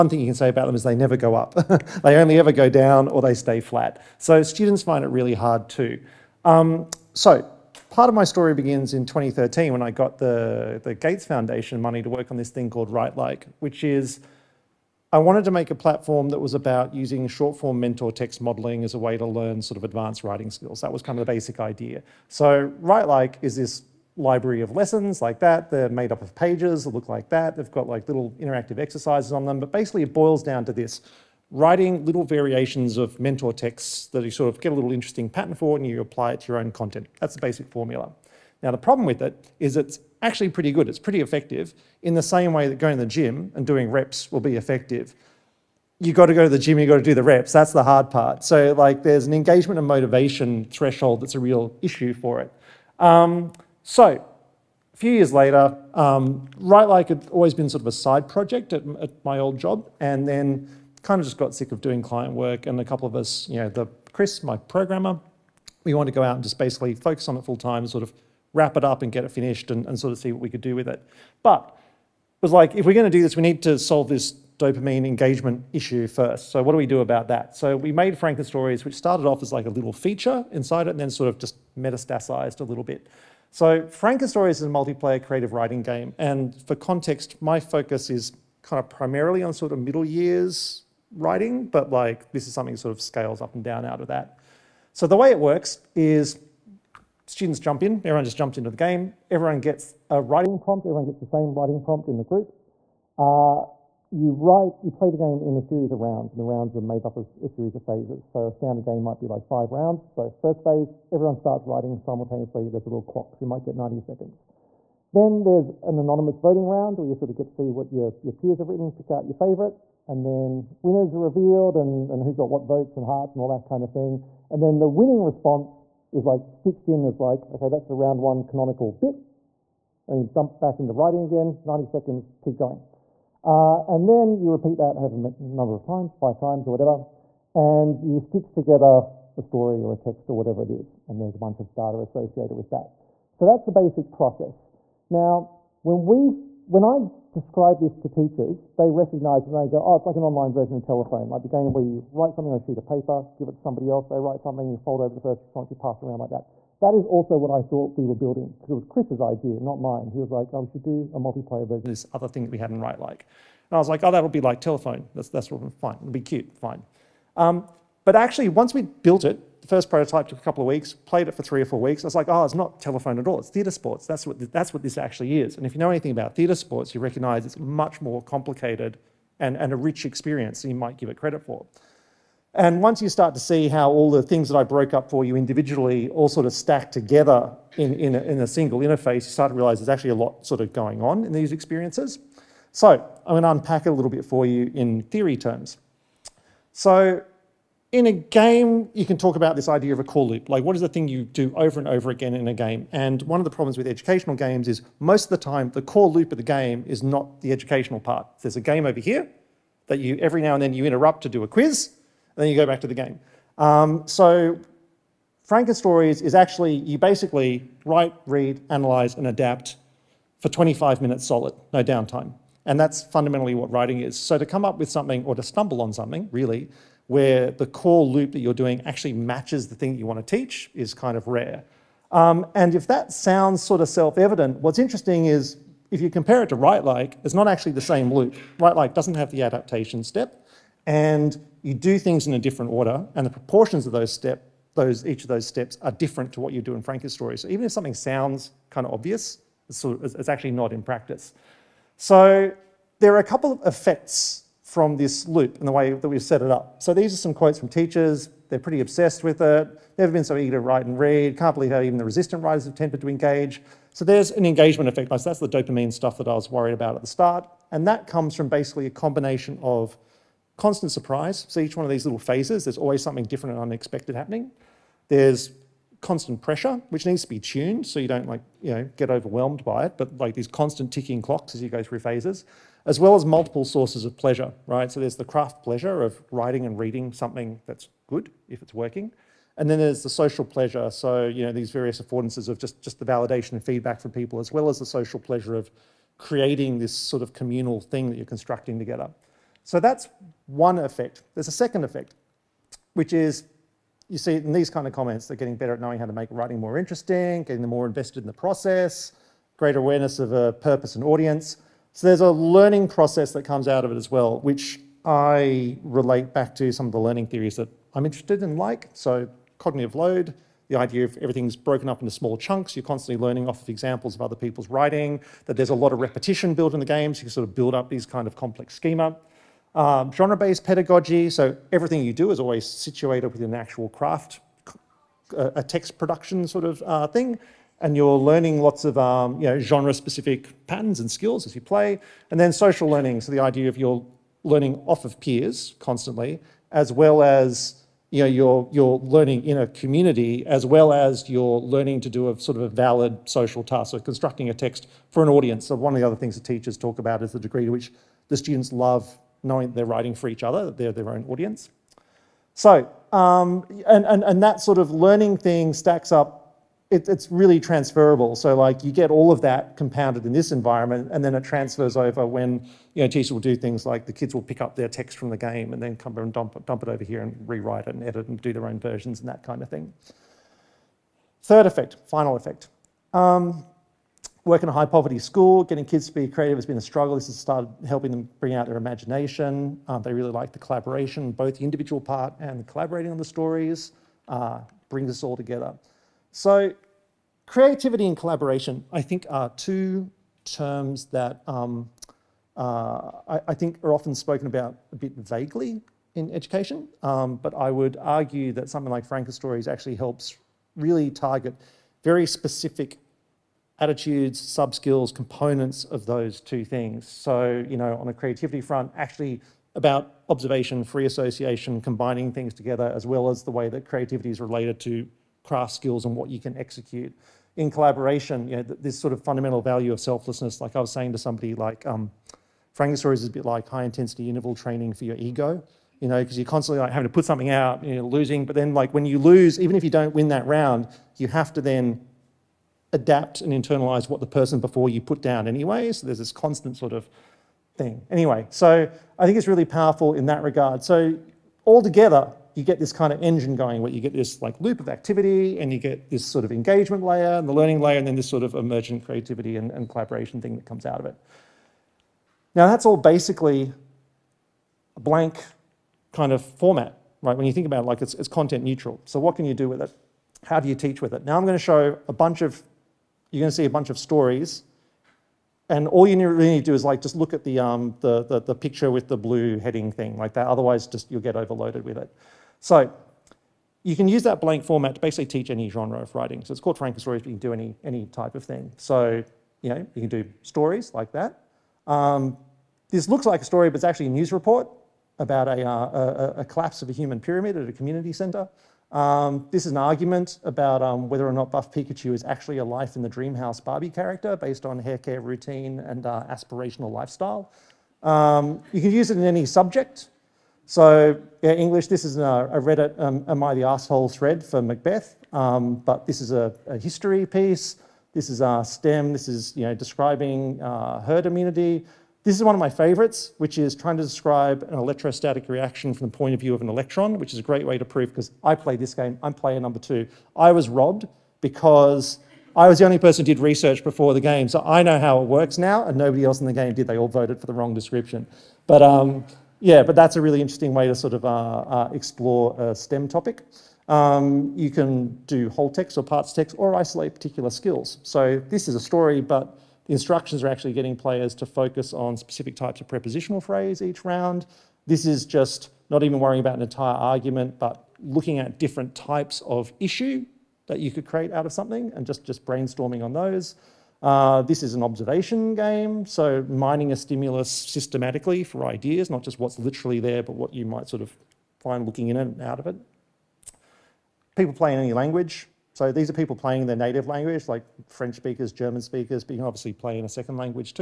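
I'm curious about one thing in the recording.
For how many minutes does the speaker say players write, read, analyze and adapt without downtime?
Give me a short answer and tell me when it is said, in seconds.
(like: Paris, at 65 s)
25, at 220 s.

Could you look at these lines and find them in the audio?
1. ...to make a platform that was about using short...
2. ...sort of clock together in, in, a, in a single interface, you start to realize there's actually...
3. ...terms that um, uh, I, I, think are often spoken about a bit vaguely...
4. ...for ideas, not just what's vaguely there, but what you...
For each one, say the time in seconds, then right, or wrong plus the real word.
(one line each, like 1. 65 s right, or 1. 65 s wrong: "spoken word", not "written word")
1. 15 s right
2. 186 s wrong: "stack", not "clock"
3. 400 s right
4. 568 s wrong: "literally", not "vaguely".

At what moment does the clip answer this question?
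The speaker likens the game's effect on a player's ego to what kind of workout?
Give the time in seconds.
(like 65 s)
433 s.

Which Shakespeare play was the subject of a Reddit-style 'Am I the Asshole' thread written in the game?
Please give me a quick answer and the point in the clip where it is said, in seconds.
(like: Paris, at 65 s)
Macbeth, at 514 s.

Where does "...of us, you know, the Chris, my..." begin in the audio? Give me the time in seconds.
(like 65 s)
63 s.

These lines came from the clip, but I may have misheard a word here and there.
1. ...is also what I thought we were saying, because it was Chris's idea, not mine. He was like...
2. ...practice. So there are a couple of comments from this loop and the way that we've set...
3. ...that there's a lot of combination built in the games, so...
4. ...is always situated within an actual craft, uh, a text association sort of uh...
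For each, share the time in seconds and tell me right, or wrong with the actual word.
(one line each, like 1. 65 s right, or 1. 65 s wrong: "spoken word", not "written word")
1. 156 s wrong: "building", not "saying"
2. 250 s wrong: "effects", not "comments"
3. 325 s wrong: "repetition", not "combination"
4. 332 s wrong: "production", not "association".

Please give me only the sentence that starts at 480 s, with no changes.
Otherwise, just you'll get overloaded with it.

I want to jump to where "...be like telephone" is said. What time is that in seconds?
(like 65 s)
164 s.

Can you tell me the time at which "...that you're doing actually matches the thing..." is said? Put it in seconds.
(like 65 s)
228 s.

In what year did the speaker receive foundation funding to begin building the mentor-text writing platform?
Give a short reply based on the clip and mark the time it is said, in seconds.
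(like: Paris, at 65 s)
2013, at 9 s.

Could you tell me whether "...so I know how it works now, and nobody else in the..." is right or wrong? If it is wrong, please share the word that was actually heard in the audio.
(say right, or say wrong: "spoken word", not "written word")
right.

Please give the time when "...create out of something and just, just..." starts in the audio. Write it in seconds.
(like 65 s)
561 s.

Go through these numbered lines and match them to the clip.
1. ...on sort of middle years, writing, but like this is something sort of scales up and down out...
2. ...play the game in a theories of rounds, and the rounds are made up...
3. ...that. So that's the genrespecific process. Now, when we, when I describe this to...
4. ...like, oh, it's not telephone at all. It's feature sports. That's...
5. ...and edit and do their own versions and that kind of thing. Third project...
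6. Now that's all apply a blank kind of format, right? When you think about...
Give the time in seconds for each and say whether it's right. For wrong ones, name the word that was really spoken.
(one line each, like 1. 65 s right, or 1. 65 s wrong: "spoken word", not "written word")
1. 89 s right
2. 104 s wrong: "series", not "theories"
3. 142 s wrong: "basic", not "genrespecific"
4. 172 s wrong: "theatre", not "feature"
5. 377 s wrong: "effect", not "project"
6. 462 s wrong: "basically", not "apply".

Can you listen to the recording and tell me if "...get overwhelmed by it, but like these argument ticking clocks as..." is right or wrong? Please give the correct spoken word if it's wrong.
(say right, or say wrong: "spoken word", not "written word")
wrong: "constant", not "argument".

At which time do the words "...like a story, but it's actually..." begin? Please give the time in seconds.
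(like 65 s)
493 s.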